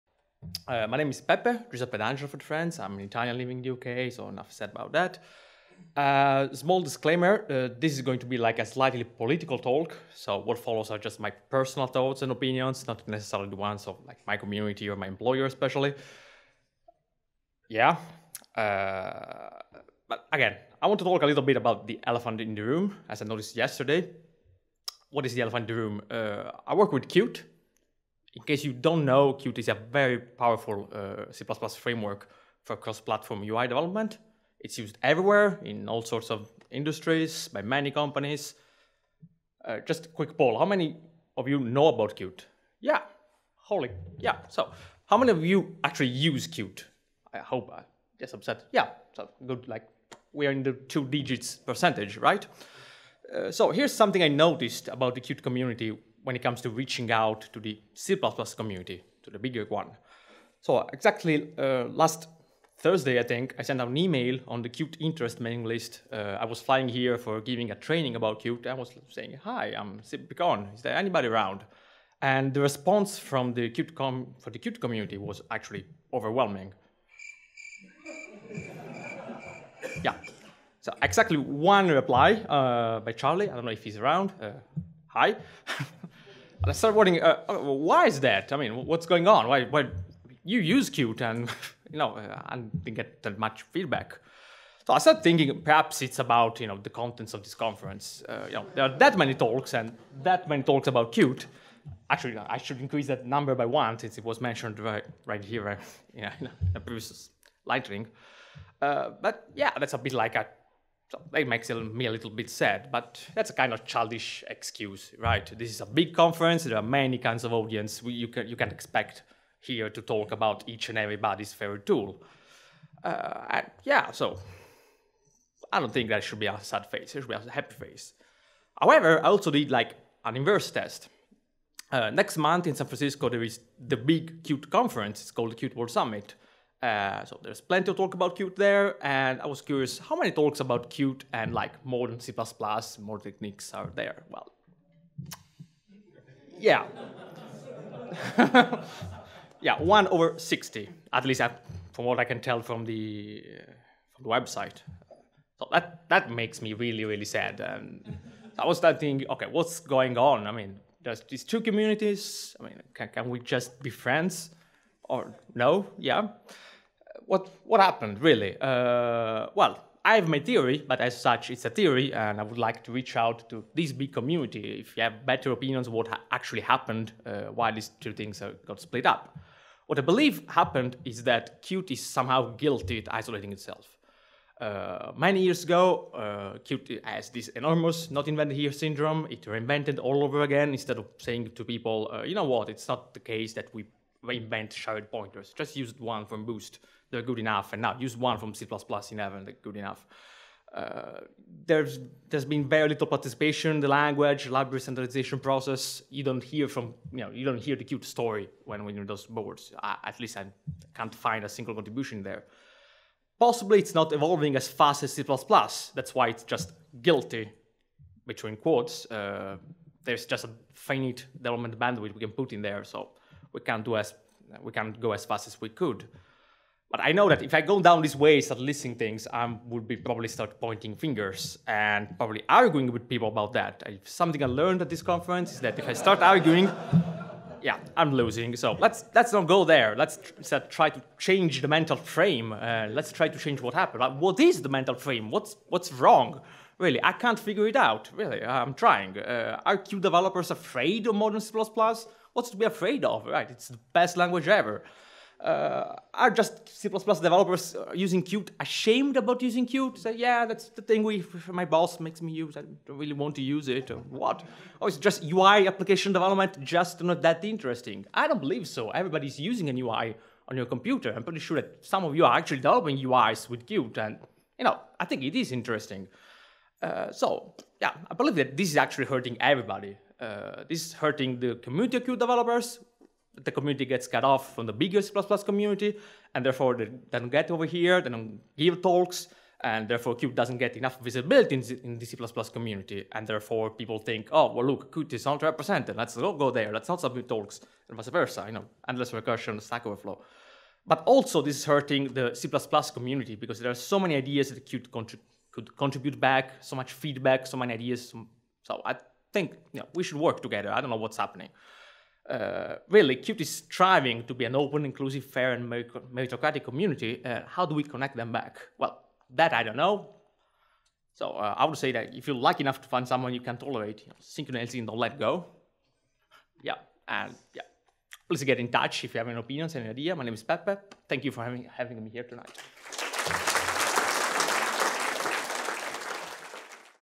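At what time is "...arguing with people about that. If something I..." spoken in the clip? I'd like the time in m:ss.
3:52.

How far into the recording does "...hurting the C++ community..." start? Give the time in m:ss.
5:01.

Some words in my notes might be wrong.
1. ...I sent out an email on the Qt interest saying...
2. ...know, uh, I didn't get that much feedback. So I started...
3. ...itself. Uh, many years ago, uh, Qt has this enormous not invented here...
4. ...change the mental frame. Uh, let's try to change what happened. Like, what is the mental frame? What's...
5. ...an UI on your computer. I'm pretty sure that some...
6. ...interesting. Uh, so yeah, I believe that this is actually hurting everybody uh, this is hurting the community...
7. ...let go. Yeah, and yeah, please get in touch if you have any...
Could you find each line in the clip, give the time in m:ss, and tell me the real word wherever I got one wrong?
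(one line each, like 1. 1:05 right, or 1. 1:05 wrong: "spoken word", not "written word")
1. 1:03 wrong: "mailing", not "saying"
2. 1:31 right
3. 3:03 right
4. 4:01 right
5. 4:29 right
6. 4:35 right
7. 5:24 right.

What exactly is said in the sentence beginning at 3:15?
Just use one from Boost, they're good enough, and now use one from C++ in heaven.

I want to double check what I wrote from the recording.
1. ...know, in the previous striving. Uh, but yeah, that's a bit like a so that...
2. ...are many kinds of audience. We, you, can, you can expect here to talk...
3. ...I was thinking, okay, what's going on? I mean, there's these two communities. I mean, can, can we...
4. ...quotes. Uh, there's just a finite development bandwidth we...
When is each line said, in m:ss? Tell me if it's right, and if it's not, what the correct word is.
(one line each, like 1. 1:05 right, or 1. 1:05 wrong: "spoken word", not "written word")
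1. 1:46 wrong: "lightning", not "striving"
2. 1:56 right
3. 2:38 right
4. 3:38 right.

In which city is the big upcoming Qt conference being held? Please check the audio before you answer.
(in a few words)
San Francisco.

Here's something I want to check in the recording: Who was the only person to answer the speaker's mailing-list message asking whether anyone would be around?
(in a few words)
Charlie.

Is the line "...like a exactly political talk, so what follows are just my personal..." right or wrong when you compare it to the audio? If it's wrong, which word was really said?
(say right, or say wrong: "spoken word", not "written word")
wrong: "slightly", not "exactly".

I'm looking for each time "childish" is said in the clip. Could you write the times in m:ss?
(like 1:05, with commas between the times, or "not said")
1:53.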